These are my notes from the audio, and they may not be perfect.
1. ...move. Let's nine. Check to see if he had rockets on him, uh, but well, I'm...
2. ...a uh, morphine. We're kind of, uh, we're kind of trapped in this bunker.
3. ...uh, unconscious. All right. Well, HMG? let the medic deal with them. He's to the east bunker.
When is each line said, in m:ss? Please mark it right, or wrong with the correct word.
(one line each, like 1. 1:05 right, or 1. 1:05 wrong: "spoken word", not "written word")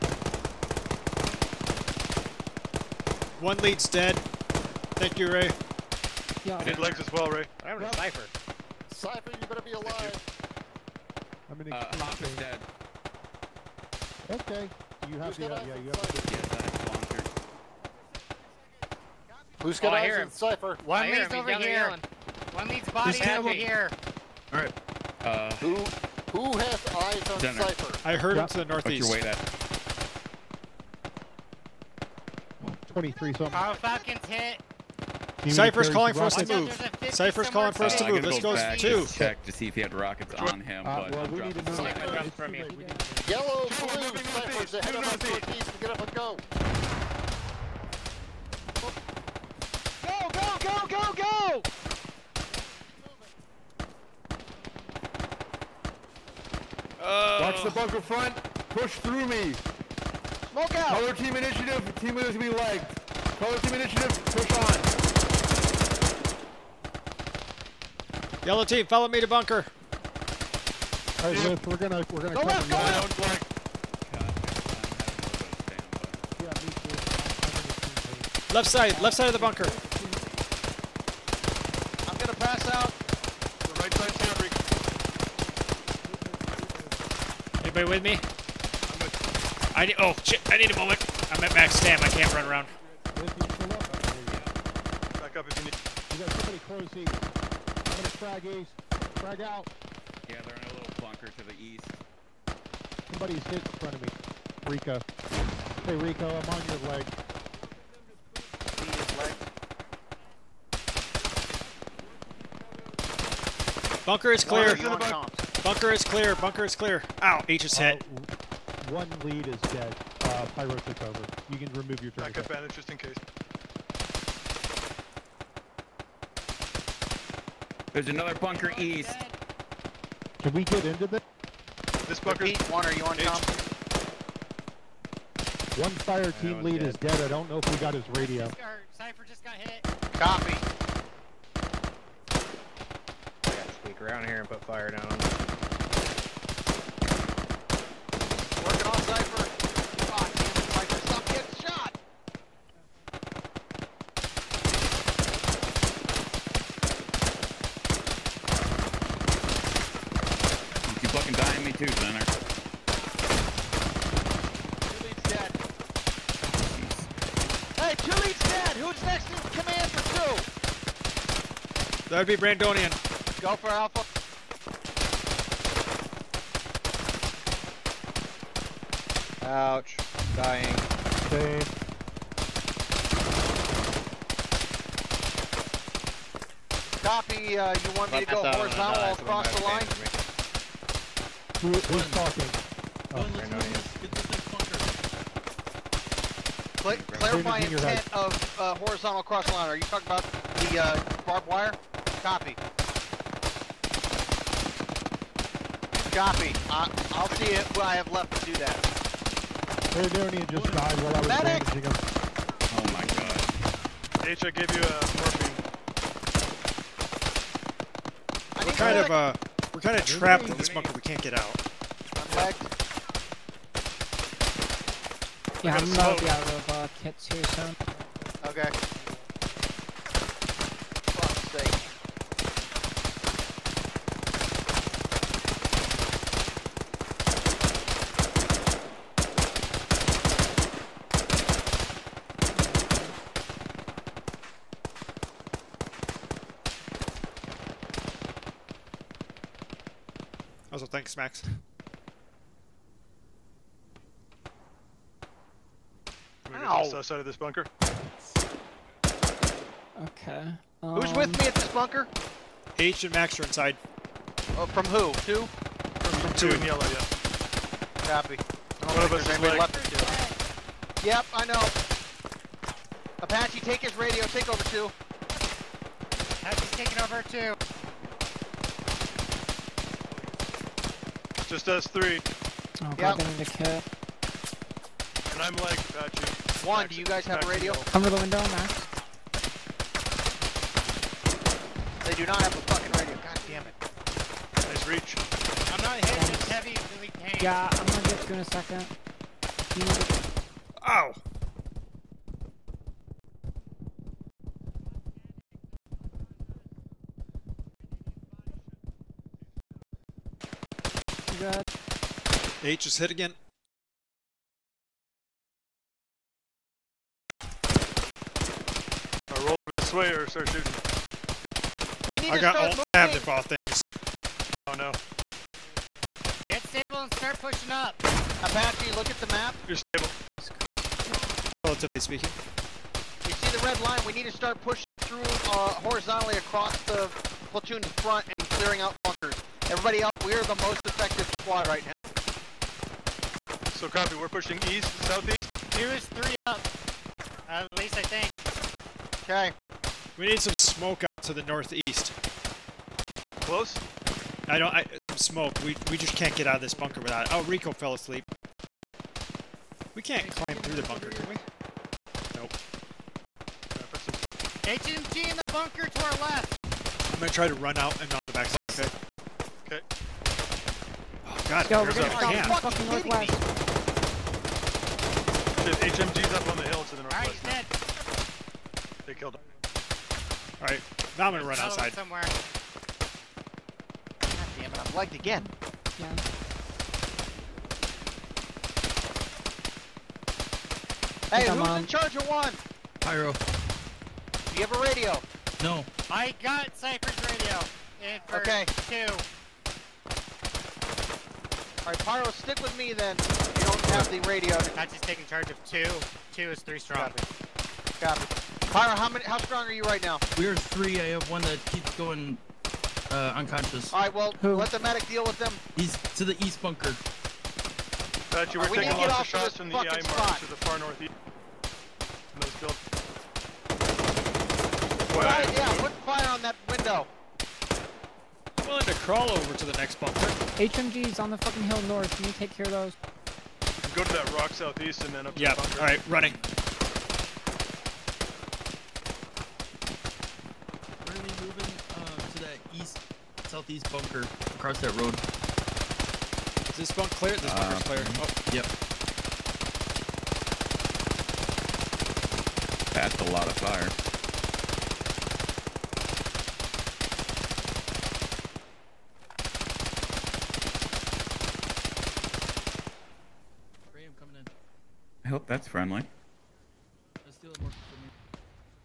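1. 0:38 wrong: "two", not "nine"
2. 3:34 right
3. 6:53 wrong: "Who", not "HMG".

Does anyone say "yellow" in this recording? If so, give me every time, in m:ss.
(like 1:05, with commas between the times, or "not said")
0:43, 1:08, 4:26.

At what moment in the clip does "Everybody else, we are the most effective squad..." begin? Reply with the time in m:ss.
5:39.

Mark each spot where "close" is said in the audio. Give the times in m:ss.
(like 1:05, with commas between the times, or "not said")
1:36, 5:53.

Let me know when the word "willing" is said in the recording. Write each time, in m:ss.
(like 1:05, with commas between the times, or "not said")
7:08.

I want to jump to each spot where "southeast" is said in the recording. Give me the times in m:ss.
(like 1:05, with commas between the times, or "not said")
5:45, 7:14, 7:23.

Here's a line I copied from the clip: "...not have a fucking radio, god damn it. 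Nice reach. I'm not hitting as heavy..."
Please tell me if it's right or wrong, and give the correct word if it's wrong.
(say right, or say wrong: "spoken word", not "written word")
right.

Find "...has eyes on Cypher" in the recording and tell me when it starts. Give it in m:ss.
0:26.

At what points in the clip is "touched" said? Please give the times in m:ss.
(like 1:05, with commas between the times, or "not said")
not said.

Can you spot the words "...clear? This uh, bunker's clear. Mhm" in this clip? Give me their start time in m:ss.
7:27.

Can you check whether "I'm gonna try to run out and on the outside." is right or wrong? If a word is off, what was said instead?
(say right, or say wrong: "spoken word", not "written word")
wrong: "backside", not "outside".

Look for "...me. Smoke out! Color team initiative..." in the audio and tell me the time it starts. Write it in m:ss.
0:59.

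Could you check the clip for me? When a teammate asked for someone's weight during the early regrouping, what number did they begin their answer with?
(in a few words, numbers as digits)
23.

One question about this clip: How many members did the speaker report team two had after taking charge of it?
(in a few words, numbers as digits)
3.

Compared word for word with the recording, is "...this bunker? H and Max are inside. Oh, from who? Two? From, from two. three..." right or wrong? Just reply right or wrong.
wrong.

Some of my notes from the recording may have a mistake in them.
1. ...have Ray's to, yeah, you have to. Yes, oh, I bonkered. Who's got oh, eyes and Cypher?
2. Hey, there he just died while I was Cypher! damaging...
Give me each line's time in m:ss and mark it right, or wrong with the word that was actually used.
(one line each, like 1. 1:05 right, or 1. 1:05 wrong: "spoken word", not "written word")
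1. 0:15 wrong: "Who", not "Ray"
2. 3:29 wrong: "Medic", not "Cypher".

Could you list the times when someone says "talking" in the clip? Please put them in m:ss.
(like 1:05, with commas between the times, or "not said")
3:12, 3:19.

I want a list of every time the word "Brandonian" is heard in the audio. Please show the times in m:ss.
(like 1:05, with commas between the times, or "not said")
2:52, 3:13.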